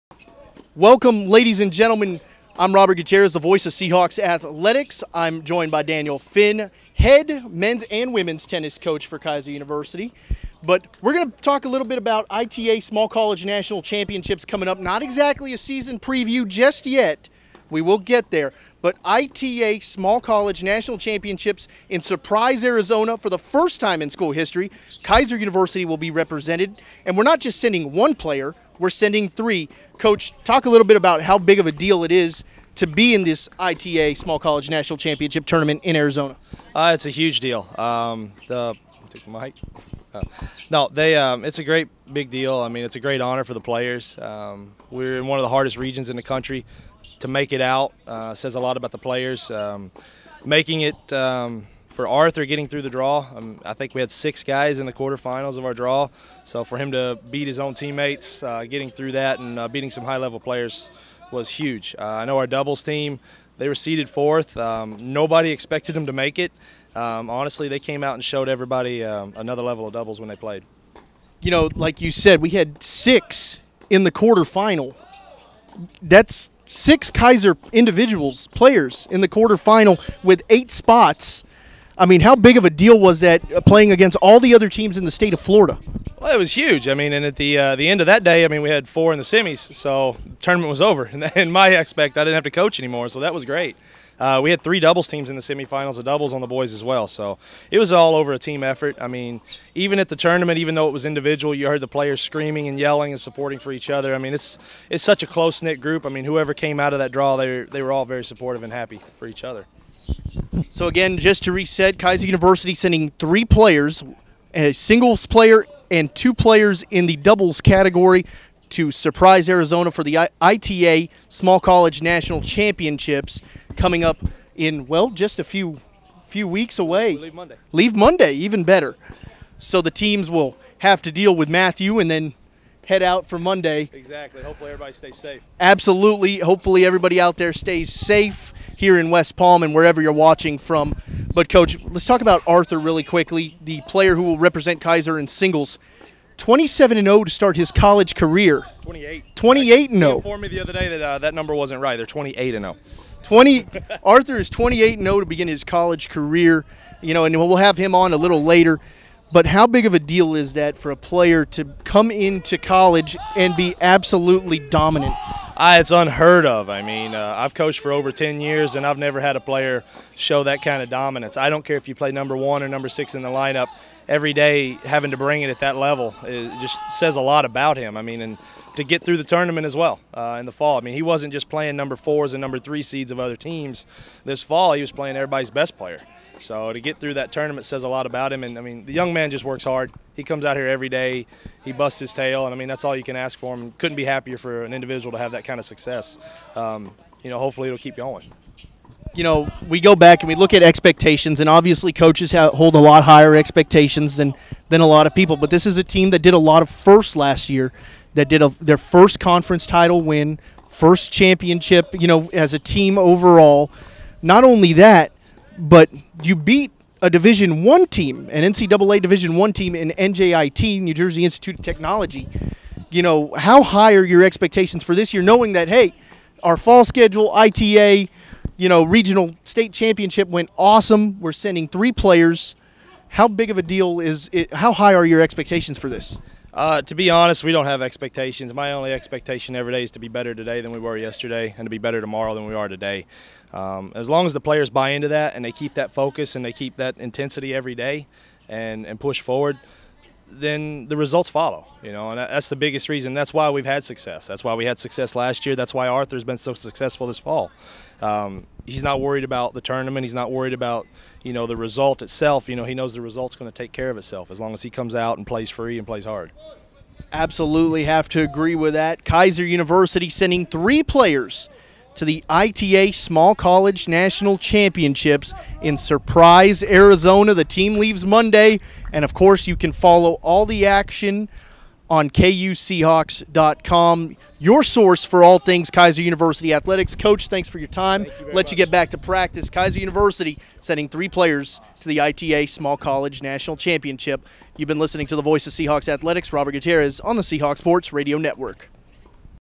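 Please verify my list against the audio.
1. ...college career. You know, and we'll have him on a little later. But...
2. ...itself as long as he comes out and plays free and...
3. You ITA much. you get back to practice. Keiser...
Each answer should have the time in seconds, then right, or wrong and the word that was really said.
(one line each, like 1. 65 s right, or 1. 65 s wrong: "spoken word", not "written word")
1. 155 s right
2. 263 s right
3. 288 s wrong: "Let", not "ITA".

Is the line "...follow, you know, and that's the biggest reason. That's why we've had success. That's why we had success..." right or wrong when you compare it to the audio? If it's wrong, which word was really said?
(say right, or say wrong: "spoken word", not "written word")
right.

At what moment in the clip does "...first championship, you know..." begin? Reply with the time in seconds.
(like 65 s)
210 s.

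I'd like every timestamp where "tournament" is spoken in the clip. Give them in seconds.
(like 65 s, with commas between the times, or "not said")
35 s, 90 s, 100 s, 179 s, 187 s, 259 s.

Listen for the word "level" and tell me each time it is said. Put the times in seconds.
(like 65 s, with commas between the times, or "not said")
60 s, 69 s, 175 s.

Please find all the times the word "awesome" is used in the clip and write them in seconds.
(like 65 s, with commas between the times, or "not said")
230 s.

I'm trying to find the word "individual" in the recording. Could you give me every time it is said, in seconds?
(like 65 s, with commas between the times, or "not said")
77 s, 101 s, 194 s.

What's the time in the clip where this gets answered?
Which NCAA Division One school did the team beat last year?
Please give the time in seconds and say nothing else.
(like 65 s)
220 s.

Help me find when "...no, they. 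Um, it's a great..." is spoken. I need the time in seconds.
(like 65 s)
40 s.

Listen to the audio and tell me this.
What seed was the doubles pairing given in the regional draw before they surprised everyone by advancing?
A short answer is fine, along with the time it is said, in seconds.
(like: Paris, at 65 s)
fourth, at 63 s.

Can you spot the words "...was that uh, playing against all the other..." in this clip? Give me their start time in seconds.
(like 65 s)
82 s.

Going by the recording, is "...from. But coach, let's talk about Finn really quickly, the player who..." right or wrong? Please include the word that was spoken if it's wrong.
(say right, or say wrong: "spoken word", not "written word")
wrong: "Arthur", not "Finn".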